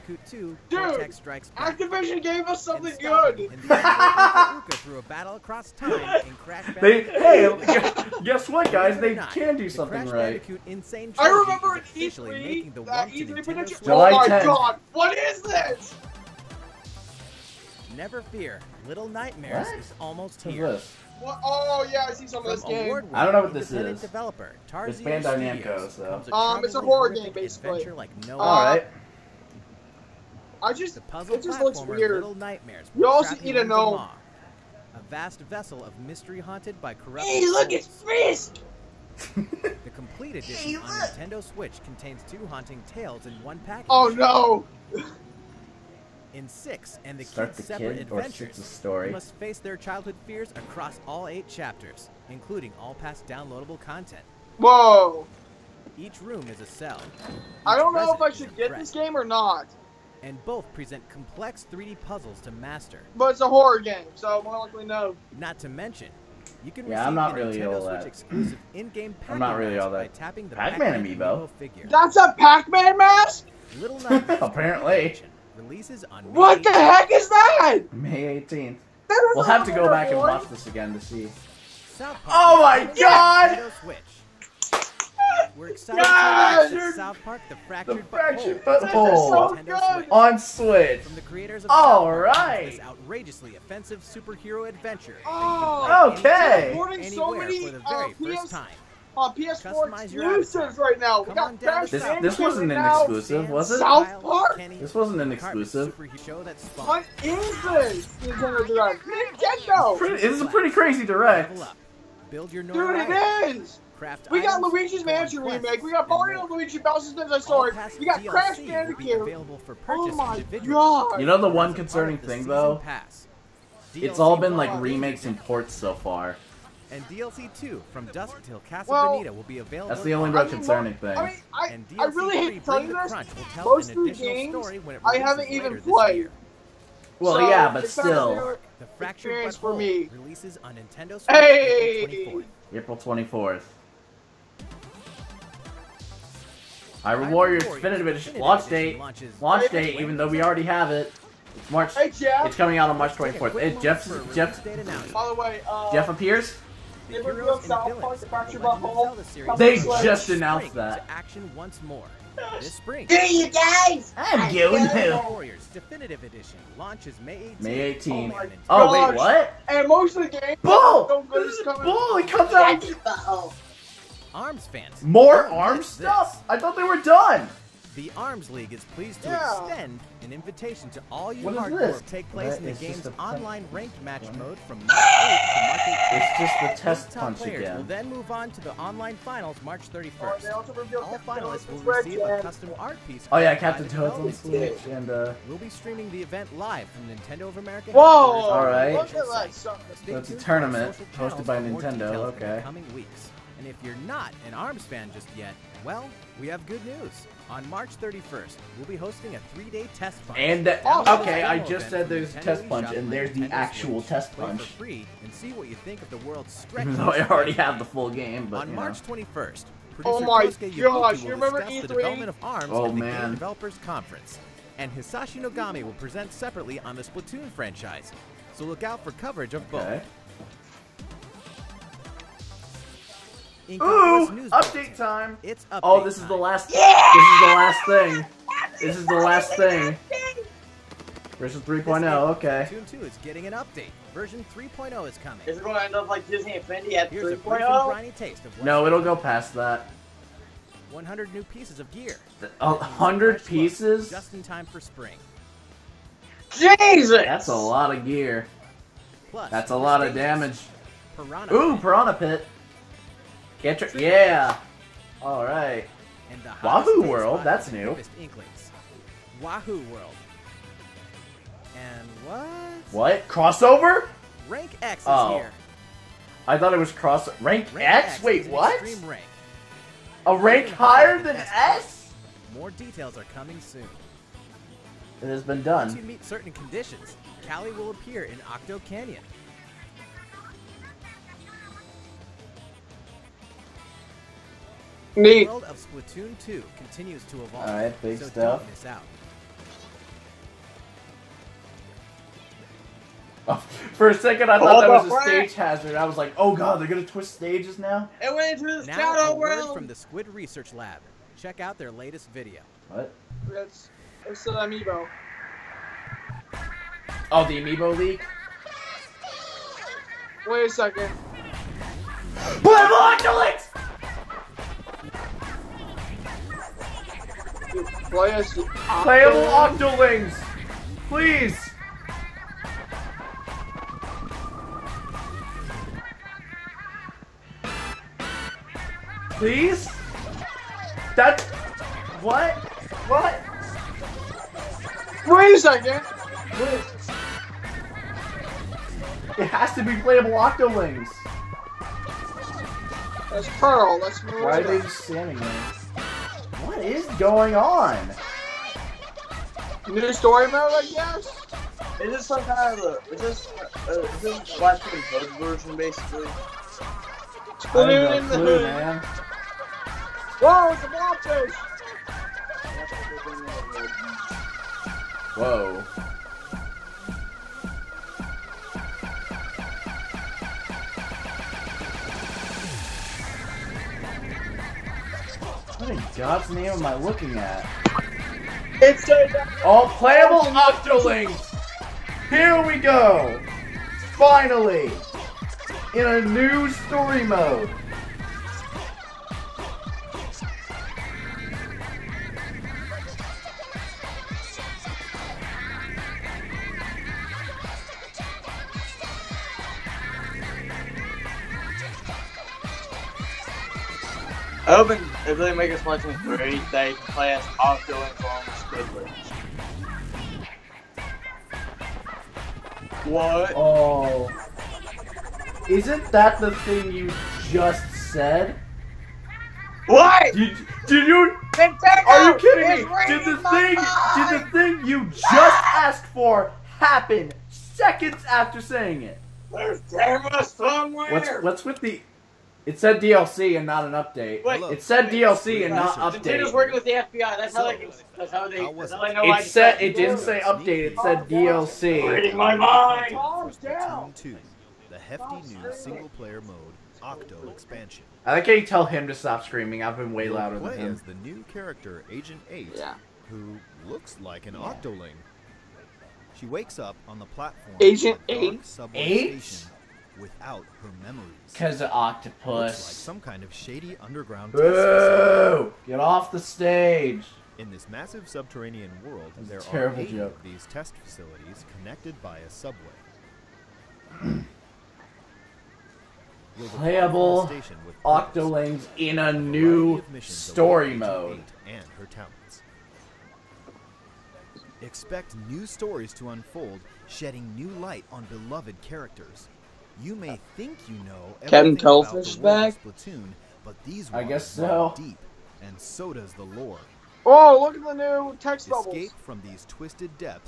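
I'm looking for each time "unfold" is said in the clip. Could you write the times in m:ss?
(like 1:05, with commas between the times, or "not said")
8:16.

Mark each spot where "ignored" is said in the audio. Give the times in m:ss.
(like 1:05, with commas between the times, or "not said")
not said.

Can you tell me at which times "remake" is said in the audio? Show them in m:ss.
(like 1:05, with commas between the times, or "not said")
1:55, 2:04.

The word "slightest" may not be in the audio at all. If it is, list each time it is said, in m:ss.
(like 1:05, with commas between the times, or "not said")
not said.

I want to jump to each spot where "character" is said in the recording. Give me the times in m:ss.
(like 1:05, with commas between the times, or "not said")
7:41, 8:18.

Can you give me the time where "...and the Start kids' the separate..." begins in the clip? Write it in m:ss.
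0:47.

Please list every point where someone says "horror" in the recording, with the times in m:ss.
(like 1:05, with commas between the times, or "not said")
0:26, 1:03.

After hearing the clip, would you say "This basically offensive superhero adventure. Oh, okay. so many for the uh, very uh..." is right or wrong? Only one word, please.
wrong.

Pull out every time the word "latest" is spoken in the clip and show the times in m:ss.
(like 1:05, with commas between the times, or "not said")
5:11.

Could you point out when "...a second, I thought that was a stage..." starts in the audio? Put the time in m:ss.
5:04.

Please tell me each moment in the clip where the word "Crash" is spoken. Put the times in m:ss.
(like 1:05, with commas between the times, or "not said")
1:41, 1:58.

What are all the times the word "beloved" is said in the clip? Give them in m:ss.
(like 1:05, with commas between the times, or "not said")
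8:18.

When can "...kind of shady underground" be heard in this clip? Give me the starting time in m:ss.
7:53.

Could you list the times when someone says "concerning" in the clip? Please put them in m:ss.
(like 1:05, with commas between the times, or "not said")
2:01, 2:10.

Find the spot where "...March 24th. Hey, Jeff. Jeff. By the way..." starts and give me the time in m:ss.
2:32.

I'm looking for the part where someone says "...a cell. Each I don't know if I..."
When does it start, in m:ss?
0:56.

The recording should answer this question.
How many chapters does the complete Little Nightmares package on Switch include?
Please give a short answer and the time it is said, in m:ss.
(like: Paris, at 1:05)
8, at 0:51.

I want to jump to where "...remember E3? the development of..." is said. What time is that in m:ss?
3:41.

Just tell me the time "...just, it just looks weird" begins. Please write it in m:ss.
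0:30.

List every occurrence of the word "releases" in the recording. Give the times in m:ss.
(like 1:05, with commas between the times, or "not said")
1:15, 2:20.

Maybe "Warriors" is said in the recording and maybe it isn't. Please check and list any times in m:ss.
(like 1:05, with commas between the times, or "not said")
2:27, 2:45.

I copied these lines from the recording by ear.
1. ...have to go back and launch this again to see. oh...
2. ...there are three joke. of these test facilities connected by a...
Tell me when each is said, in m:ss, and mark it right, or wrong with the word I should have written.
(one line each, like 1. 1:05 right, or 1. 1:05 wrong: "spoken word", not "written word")
1. 1:19 wrong: "watch", not "launch"
2. 7:59 wrong: "eight", not "three".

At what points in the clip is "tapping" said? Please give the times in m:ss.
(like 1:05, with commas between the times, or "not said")
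1:10.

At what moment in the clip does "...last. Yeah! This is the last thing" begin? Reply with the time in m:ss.
3:56.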